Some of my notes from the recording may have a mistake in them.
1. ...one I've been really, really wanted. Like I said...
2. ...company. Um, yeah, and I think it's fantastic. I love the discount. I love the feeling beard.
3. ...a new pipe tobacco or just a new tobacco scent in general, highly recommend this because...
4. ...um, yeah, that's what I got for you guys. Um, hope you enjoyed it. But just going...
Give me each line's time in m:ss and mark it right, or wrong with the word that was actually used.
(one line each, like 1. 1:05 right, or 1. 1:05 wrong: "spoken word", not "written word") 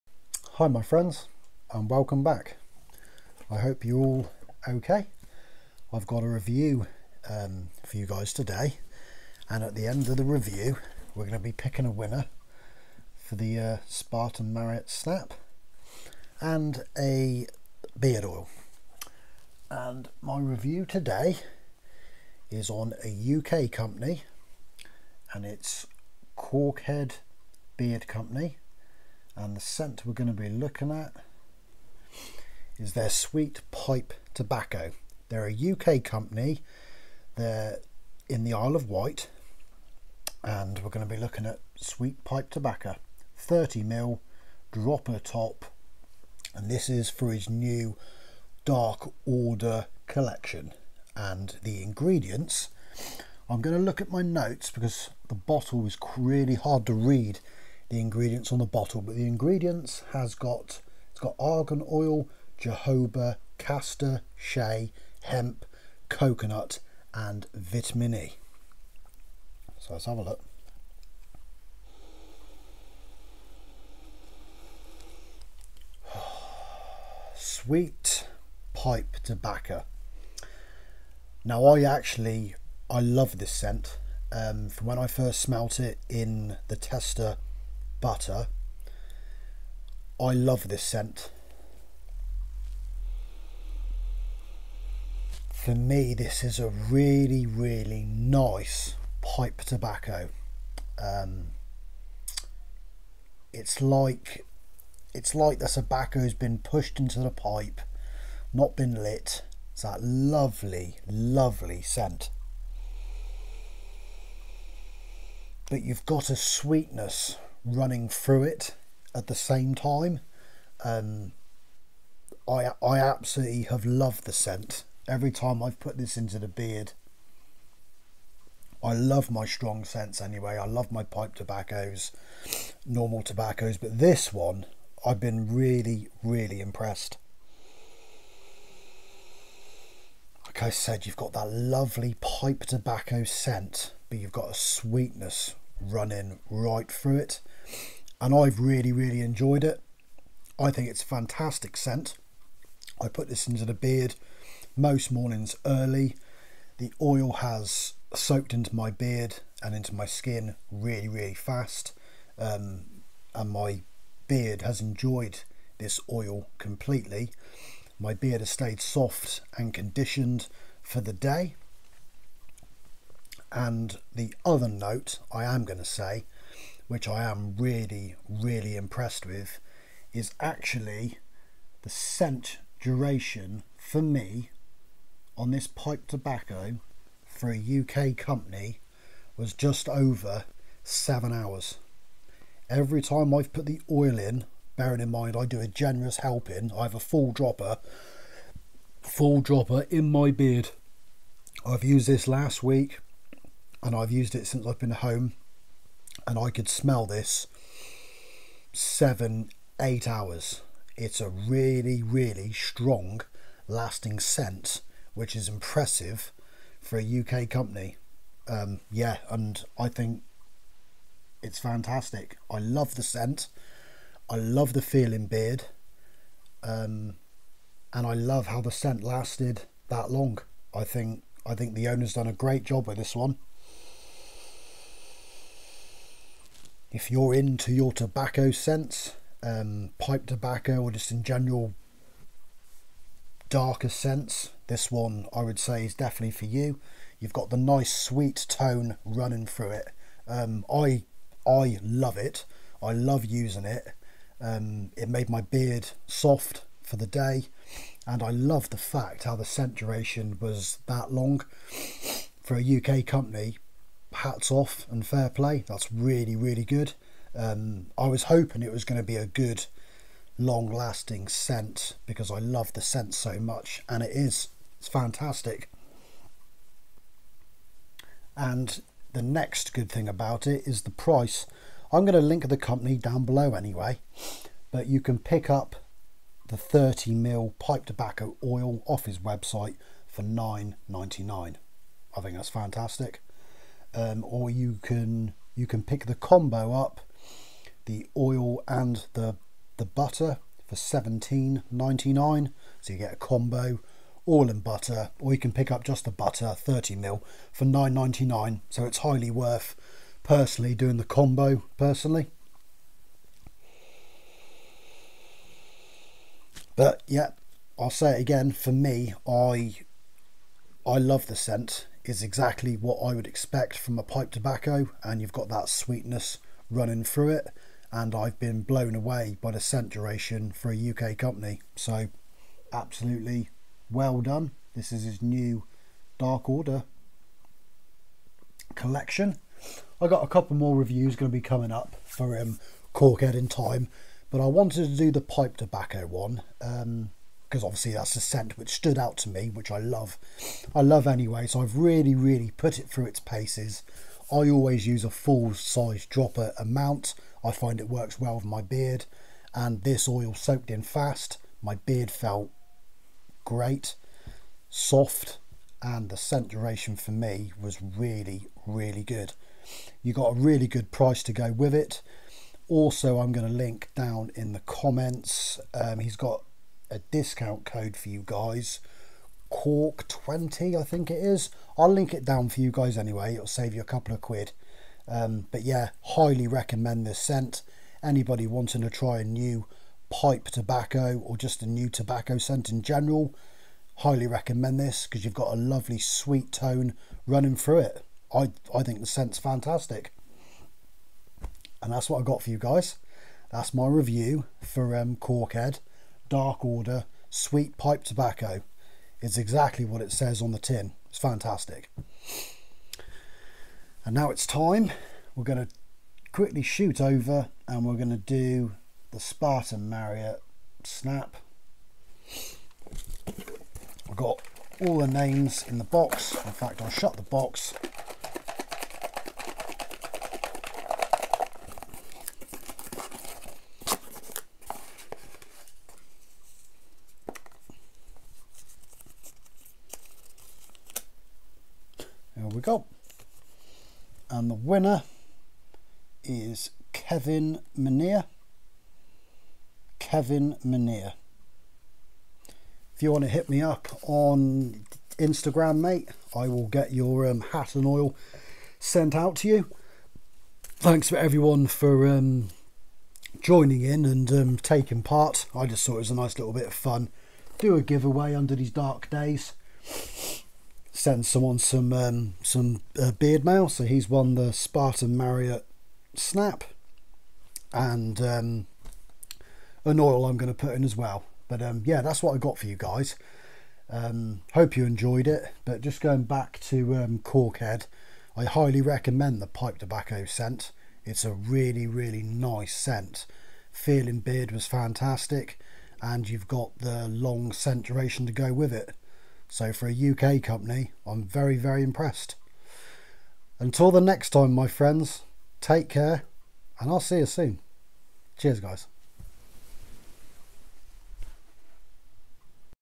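1. 2:14 wrong: "impressed", not "wanted"
2. 3:37 wrong: "scent", not "discount"
3. 6:29 right
4. 8:01 right.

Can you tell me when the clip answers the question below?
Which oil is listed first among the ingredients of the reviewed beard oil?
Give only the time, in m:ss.
1:01.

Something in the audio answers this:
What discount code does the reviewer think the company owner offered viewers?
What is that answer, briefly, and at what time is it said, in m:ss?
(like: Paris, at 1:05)
Caulk 20, at 6:19.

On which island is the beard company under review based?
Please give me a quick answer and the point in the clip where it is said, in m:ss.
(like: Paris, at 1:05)
Isle of Wight, at 0:38.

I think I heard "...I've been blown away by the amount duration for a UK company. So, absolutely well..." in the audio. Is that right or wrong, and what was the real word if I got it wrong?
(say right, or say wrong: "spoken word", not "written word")
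wrong: "scent", not "amount".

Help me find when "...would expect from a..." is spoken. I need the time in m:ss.
5:23.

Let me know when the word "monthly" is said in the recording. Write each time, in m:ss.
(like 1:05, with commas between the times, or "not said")
not said.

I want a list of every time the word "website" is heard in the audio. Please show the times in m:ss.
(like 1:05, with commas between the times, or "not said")
4:49.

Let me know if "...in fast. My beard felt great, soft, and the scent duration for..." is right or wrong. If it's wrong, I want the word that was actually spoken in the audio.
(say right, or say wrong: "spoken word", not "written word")
right.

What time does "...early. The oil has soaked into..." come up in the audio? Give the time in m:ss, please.
2:35.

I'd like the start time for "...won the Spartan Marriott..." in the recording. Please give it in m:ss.
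7:54.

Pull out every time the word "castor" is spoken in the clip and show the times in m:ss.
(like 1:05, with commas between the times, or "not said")
1:03.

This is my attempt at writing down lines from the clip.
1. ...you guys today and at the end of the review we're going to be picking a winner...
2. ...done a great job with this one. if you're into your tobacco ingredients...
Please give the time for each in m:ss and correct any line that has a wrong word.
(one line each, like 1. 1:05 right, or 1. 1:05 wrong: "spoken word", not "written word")
1. 0:07 right
2. 3:52 wrong: "scents", not "ingredients".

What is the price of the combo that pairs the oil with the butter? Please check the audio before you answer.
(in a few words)
17.99.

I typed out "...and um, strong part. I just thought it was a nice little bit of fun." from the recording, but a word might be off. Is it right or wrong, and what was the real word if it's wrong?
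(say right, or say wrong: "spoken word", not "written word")
wrong: "taking", not "strong".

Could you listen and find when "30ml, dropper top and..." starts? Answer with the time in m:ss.
0:43.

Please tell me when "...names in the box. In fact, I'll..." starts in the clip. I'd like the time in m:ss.
7:05.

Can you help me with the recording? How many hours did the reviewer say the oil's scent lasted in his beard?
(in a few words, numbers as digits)
just over 7 hours.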